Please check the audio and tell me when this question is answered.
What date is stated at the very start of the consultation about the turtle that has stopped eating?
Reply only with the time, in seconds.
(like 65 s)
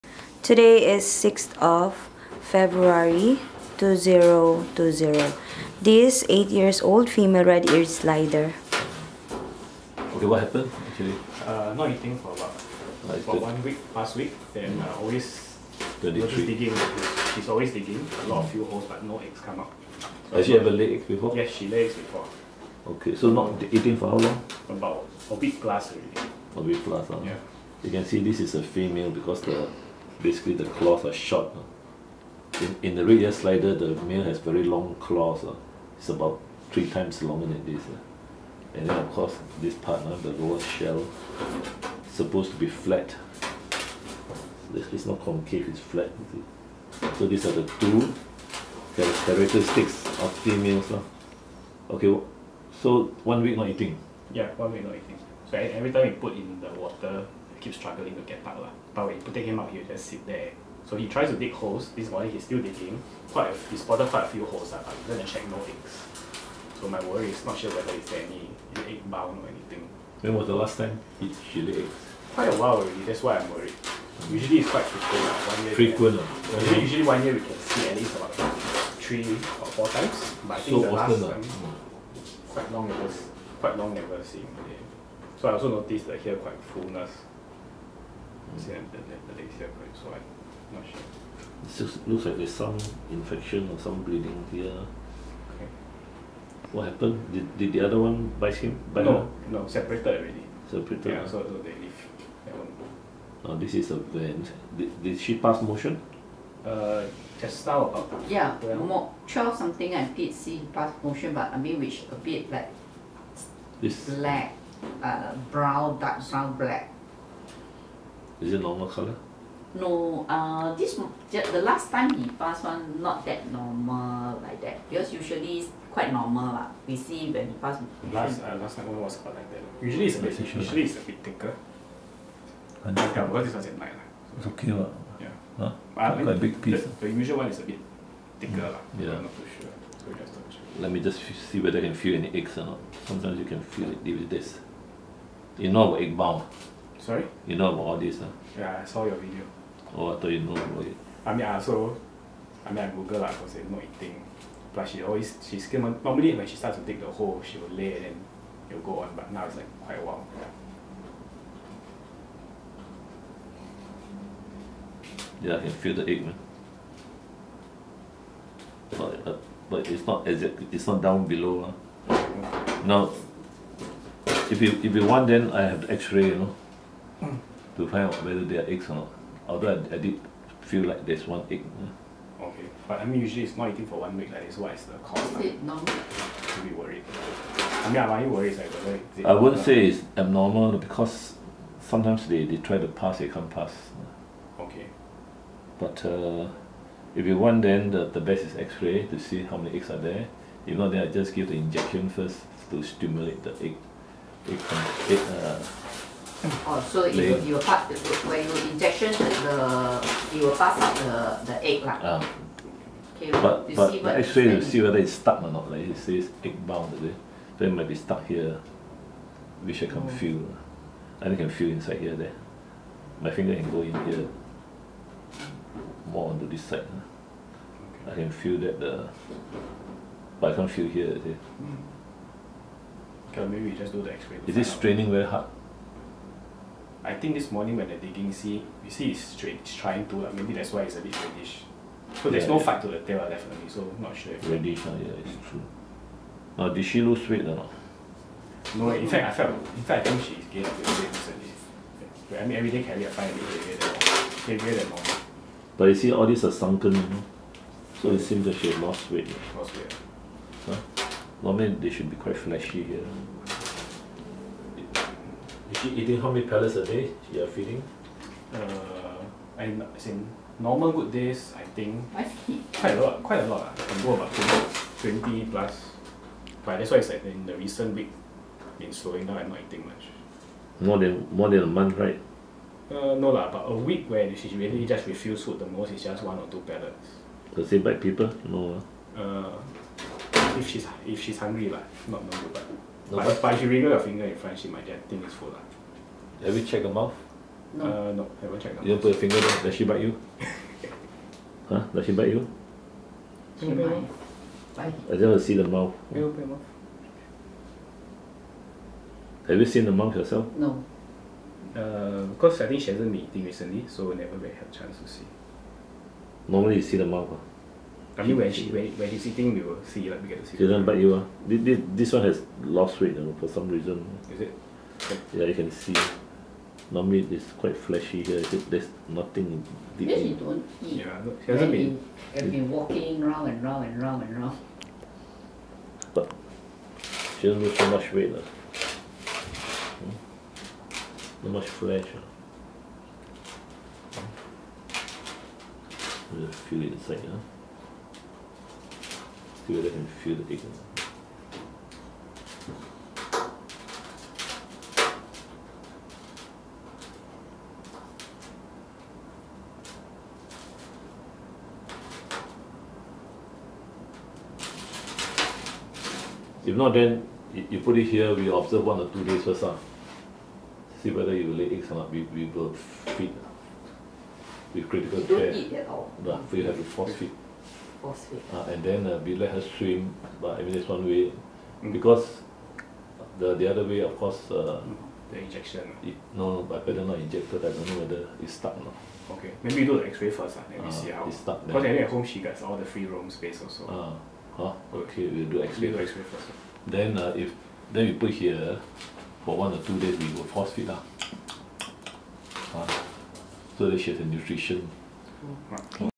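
1 s.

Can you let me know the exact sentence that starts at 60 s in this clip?
So he tries to dig holes.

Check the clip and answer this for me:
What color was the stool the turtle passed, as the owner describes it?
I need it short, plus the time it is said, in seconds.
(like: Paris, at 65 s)
Dark brown, black, at 115 s.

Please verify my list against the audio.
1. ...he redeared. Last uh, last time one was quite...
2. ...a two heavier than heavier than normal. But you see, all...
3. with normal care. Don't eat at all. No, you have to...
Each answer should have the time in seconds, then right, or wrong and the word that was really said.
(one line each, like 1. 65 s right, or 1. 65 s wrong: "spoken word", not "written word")
1. 127 s wrong: "passed", not "redeared"
2. 253 s wrong: "five", not "two"
3. 374 s wrong: "critical", not "normal".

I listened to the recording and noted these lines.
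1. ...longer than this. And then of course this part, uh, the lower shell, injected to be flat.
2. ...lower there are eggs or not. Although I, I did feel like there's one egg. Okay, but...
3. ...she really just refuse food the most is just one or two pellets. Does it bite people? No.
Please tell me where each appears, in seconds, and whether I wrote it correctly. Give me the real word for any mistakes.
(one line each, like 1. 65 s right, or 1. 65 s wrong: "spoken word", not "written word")
1. 37 s wrong: "supposed", not "injected"
2. 178 s wrong: "whether", not "lower"
3. 284 s right.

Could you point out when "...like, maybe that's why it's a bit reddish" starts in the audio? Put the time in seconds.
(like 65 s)
240 s.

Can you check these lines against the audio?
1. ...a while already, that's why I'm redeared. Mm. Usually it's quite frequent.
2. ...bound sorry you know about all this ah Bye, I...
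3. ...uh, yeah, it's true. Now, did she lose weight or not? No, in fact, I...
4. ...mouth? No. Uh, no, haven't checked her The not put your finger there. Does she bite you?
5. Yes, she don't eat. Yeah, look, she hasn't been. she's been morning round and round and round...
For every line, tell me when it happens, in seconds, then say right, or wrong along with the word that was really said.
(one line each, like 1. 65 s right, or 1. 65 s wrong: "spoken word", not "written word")
1. 72 s wrong: "worried", not "redeared"
2. 146 s wrong: "Yeah", not "Bye"
3. 244 s right
4. 296 s wrong: "You", not "The"
5. 330 s wrong: "walking", not "morning".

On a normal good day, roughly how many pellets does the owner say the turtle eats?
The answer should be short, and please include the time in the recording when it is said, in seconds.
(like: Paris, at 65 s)
20 plus, at 275 s.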